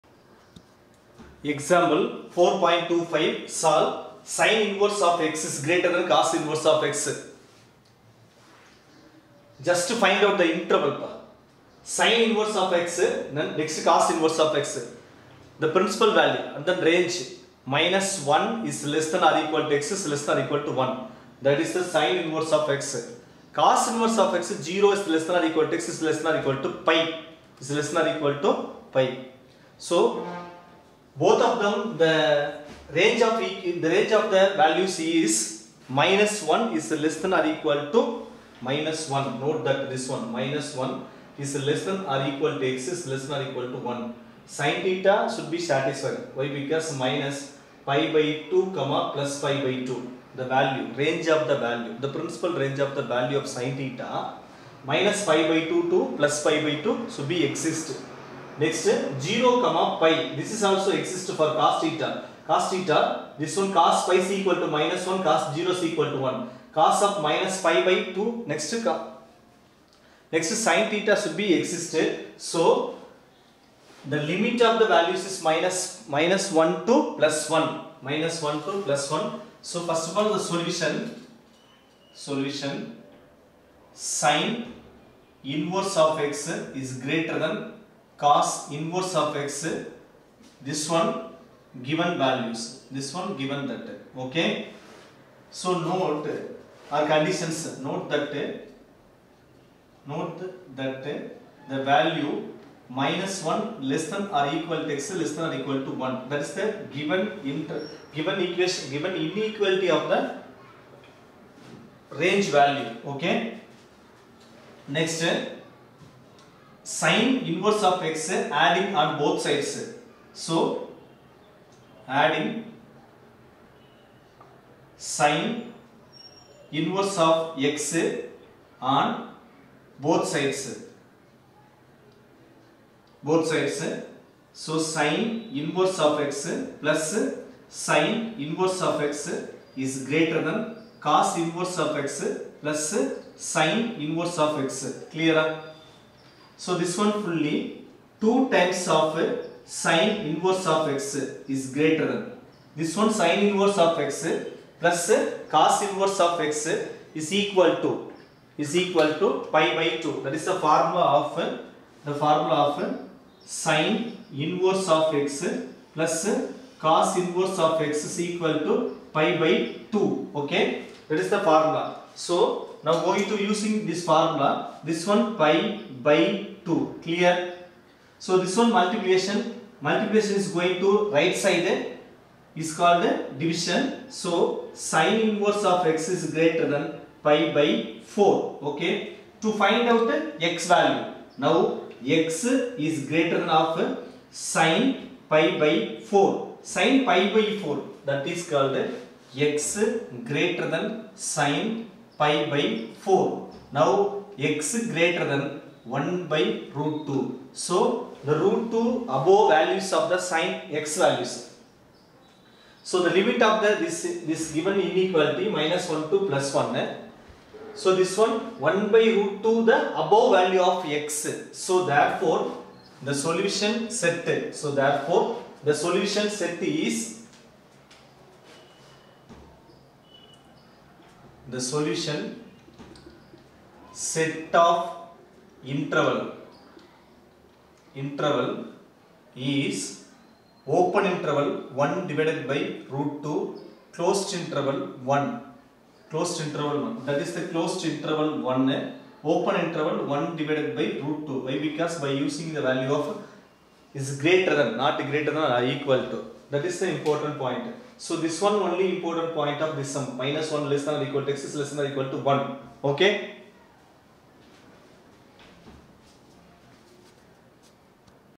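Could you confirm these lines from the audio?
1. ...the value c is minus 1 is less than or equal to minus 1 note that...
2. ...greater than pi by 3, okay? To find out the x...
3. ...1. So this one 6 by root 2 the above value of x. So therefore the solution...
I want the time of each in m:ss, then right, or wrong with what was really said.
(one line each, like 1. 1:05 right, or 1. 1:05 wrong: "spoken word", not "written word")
1. 0:34 right
2. 3:06 wrong: "4", not "3"
3. 3:36 wrong: "1", not "6".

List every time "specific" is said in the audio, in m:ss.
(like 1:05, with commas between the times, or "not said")
not said.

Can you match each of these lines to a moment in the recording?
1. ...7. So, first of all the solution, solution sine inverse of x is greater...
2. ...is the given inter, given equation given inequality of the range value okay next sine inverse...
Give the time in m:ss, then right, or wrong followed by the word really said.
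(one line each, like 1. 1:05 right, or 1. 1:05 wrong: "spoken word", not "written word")
1. 1:19 wrong: "1", not "7"
2. 1:46 right.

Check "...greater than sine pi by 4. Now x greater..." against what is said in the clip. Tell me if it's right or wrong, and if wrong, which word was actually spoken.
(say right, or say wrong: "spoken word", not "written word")
right.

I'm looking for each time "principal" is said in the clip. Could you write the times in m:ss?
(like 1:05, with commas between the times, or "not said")
0:15, 0:52.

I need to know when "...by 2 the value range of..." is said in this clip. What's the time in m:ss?
0:49.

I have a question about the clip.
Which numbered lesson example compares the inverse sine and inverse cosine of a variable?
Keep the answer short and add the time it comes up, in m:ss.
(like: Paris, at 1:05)
4.25, at 0:01.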